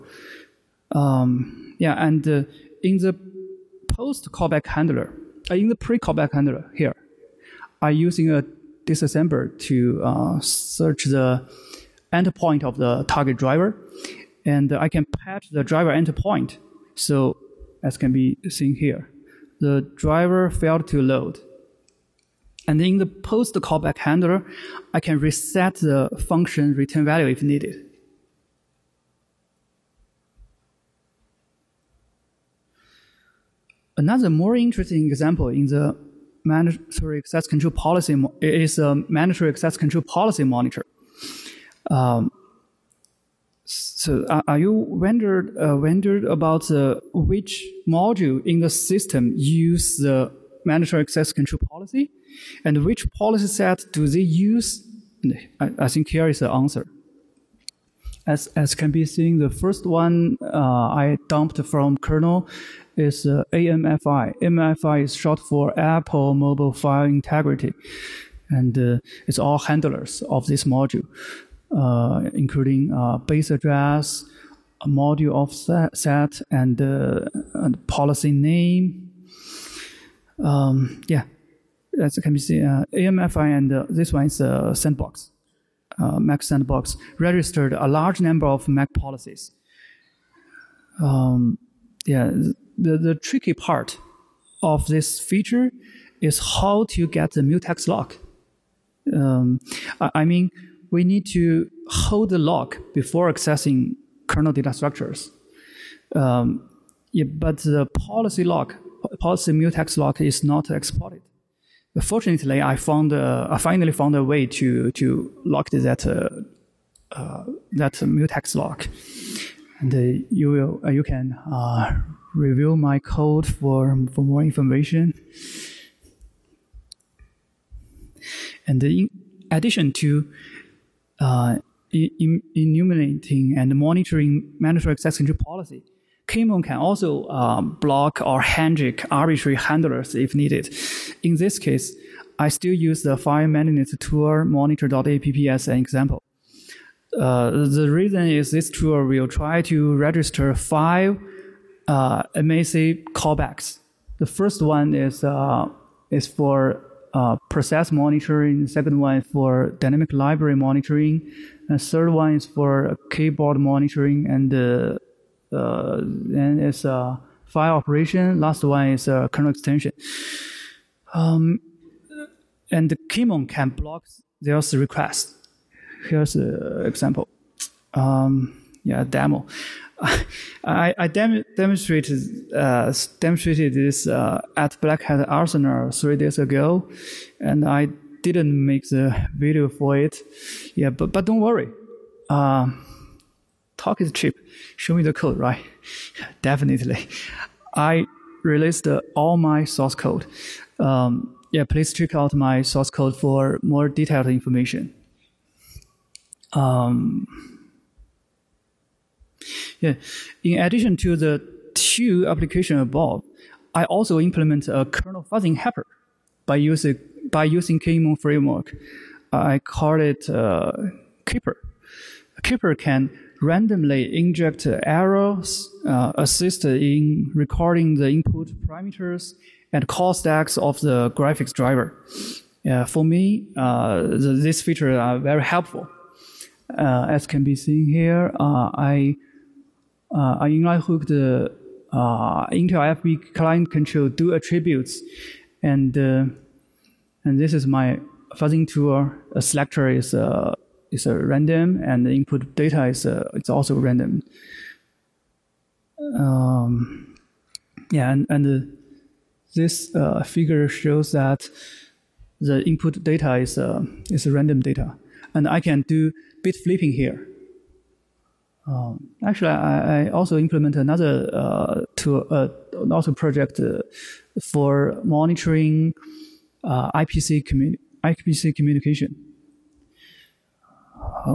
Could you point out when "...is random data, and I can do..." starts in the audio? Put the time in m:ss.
4:24.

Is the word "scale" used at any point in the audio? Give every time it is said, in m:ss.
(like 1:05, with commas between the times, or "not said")
not said.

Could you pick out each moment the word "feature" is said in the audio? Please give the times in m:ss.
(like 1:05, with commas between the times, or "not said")
1:35, 3:54.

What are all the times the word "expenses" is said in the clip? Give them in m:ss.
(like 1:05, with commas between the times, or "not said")
not said.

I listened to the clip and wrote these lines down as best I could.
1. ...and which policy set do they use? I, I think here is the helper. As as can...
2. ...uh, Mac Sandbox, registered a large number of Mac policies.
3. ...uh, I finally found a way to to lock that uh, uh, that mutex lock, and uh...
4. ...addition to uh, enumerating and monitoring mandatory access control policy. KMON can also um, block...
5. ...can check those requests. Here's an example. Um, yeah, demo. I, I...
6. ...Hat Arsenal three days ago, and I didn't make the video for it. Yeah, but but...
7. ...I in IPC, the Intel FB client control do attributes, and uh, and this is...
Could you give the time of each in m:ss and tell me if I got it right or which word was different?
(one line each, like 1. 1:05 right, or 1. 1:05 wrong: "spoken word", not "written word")
1. 0:52 wrong: "answer", not "helper"
2. 1:25 right
3. 1:53 right
4. 2:09 right
5. 2:53 wrong: "block", not "check"
6. 3:05 right
7. 3:58 wrong: "Lighthook", not "IPC".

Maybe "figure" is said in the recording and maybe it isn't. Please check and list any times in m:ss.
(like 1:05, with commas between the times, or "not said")
4:20.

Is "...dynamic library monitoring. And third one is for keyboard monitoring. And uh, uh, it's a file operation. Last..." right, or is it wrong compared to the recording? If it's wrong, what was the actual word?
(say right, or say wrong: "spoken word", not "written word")
right.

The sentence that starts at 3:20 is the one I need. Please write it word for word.
Um, yeah, please check out my source code for more detailed information.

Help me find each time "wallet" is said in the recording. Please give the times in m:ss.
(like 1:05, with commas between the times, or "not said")
not said.